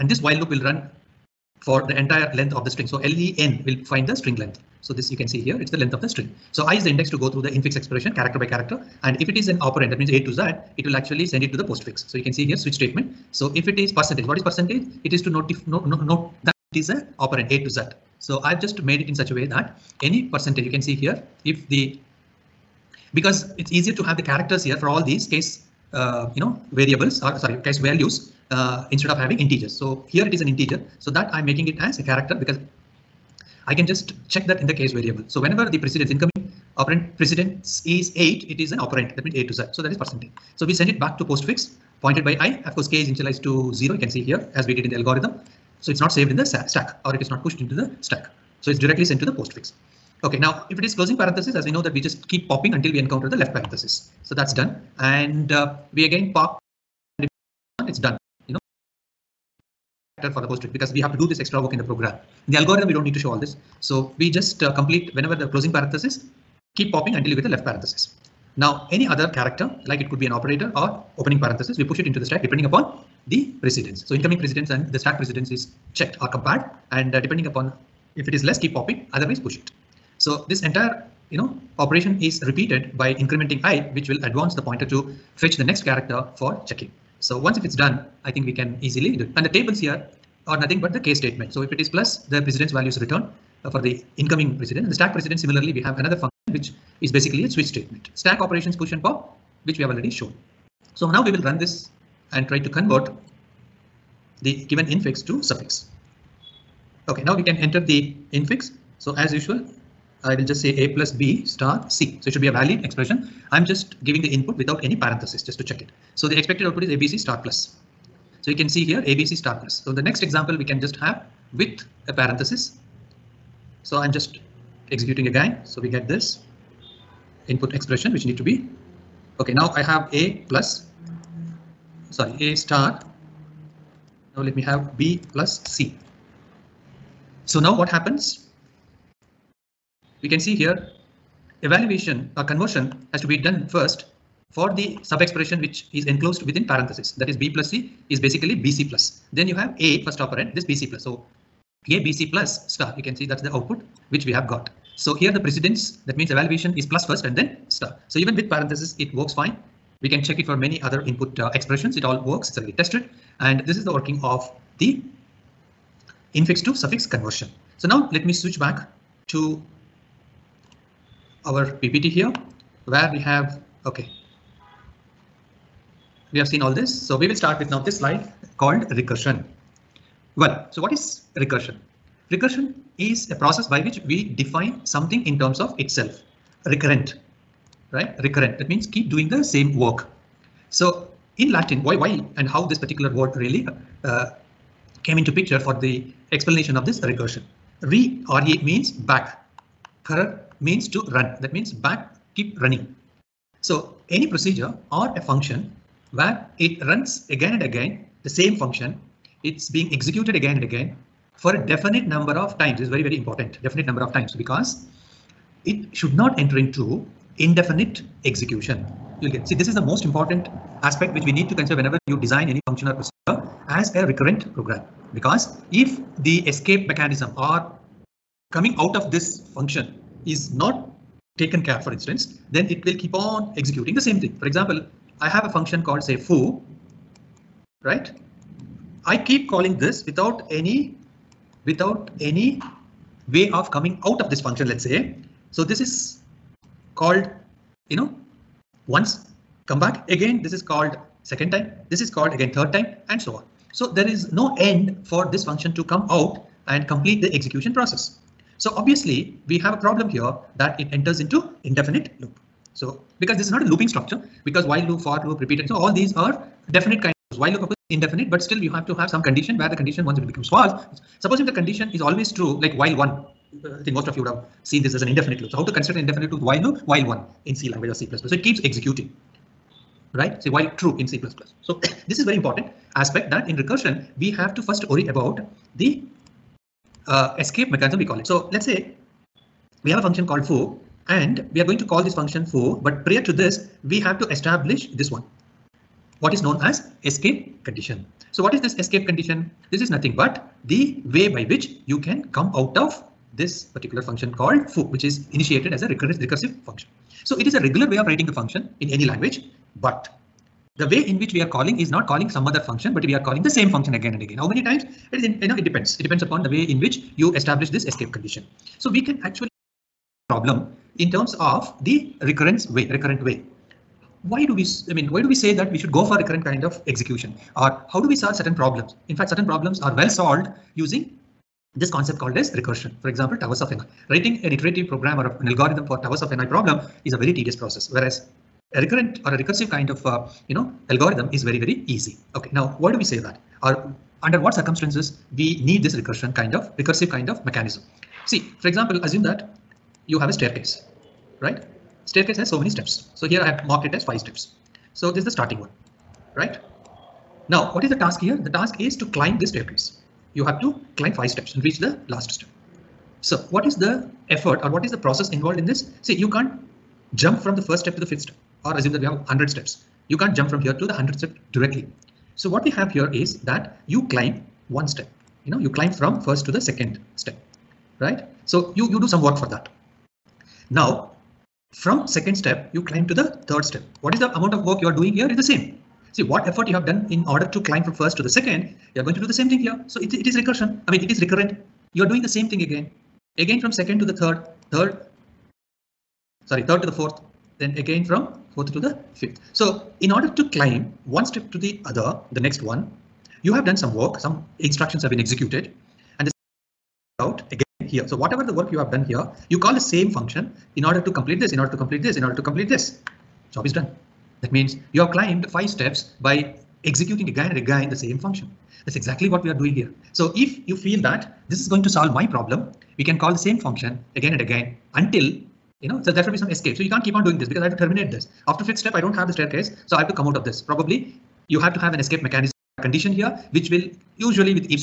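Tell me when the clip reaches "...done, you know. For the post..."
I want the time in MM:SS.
00:57.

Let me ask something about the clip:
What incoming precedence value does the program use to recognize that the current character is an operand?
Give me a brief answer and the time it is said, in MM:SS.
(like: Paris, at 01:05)
8, at 00:37.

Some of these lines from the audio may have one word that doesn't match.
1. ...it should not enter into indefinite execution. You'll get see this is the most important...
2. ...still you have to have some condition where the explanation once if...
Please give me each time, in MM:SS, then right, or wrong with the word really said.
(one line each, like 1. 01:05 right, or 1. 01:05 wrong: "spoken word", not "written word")
1. 03:35 right
2. 04:28 wrong: "condition", not "explanation".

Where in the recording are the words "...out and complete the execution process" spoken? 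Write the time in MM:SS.
04:16.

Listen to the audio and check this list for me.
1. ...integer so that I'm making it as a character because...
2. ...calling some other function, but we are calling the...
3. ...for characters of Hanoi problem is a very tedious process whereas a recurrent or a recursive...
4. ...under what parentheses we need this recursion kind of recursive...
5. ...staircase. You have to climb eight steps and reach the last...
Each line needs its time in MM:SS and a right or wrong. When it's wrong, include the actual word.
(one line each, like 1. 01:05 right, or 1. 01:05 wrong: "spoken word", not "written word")
1. 00:30 right
2. 05:12 right
3. 05:35 wrong: "towers", not "characters"
4. 05:44 wrong: "circumstances", not "parentheses"
5. 05:59 wrong: "five", not "eight".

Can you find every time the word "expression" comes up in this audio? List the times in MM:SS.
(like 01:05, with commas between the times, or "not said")
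00:07, 01:52, 02:07, 02:25, 02:41.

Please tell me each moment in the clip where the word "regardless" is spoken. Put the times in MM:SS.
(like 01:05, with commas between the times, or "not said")
not said.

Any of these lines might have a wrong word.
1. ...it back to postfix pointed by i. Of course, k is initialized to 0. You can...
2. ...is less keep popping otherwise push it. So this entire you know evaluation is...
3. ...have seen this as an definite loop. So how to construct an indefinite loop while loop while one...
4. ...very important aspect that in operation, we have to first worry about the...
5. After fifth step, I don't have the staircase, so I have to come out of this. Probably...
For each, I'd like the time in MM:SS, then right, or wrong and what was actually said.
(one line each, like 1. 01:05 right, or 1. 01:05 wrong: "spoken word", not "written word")
1. 00:40 right
2. 01:18 wrong: "operation", not "evaluation"
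3. 04:34 wrong: "indefinite", not "definite"
4. 04:42 wrong: "recursion", not "operation"
5. 07:08 right.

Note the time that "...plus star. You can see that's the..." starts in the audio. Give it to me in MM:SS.
02:32.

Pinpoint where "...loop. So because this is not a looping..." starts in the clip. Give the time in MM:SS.
04:22.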